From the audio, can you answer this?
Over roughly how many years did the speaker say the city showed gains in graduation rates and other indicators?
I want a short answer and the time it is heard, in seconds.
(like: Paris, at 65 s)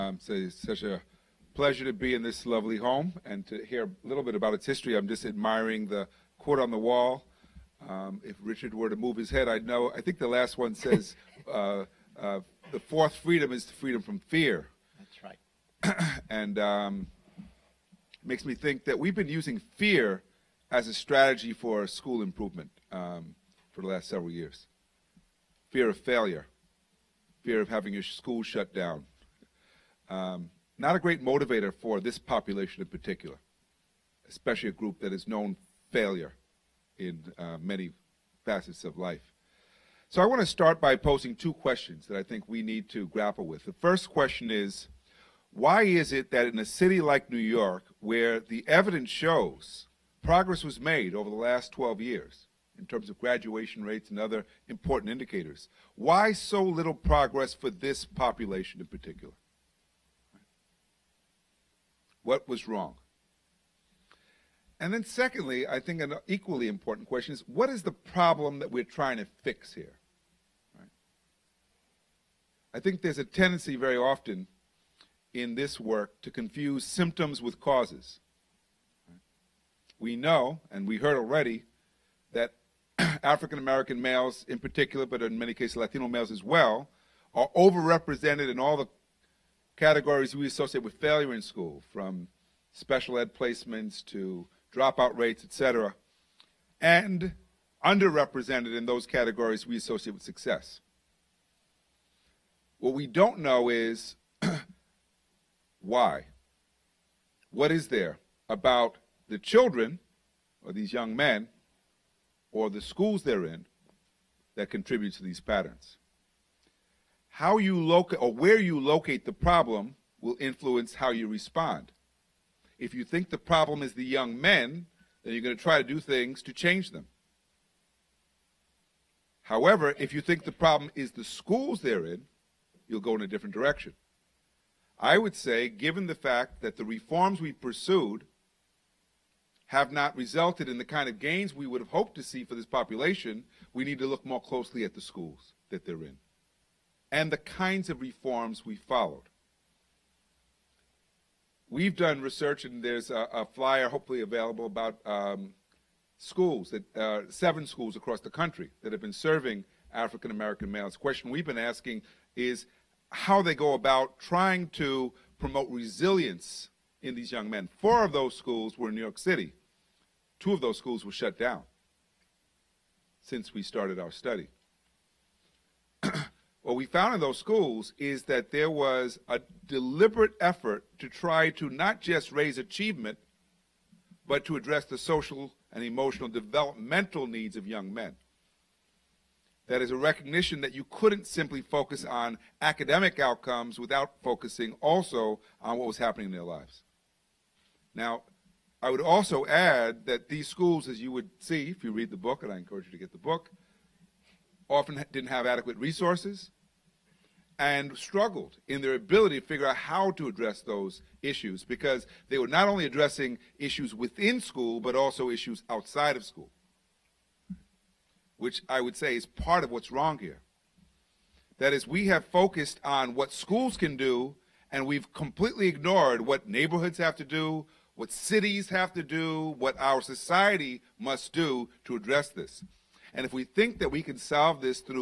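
12, at 51 s.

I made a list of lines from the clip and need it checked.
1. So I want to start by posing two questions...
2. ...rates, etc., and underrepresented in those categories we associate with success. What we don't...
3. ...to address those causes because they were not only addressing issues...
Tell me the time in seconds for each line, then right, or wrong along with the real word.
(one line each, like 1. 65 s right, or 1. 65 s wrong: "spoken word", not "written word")
1. 40 s right
2. 95 s right
3. 210 s wrong: "issues", not "causes".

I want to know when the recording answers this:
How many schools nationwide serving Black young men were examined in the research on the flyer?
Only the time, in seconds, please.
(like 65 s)
157 s.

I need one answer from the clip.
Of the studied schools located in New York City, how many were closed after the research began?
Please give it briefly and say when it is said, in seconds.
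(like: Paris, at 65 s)
2, at 170 s.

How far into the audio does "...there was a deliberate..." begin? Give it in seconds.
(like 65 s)
178 s.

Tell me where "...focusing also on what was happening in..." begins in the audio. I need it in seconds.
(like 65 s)
194 s.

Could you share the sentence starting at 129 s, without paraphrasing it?
However, if you think the problem is the schools they're in, you'll go in a different direction.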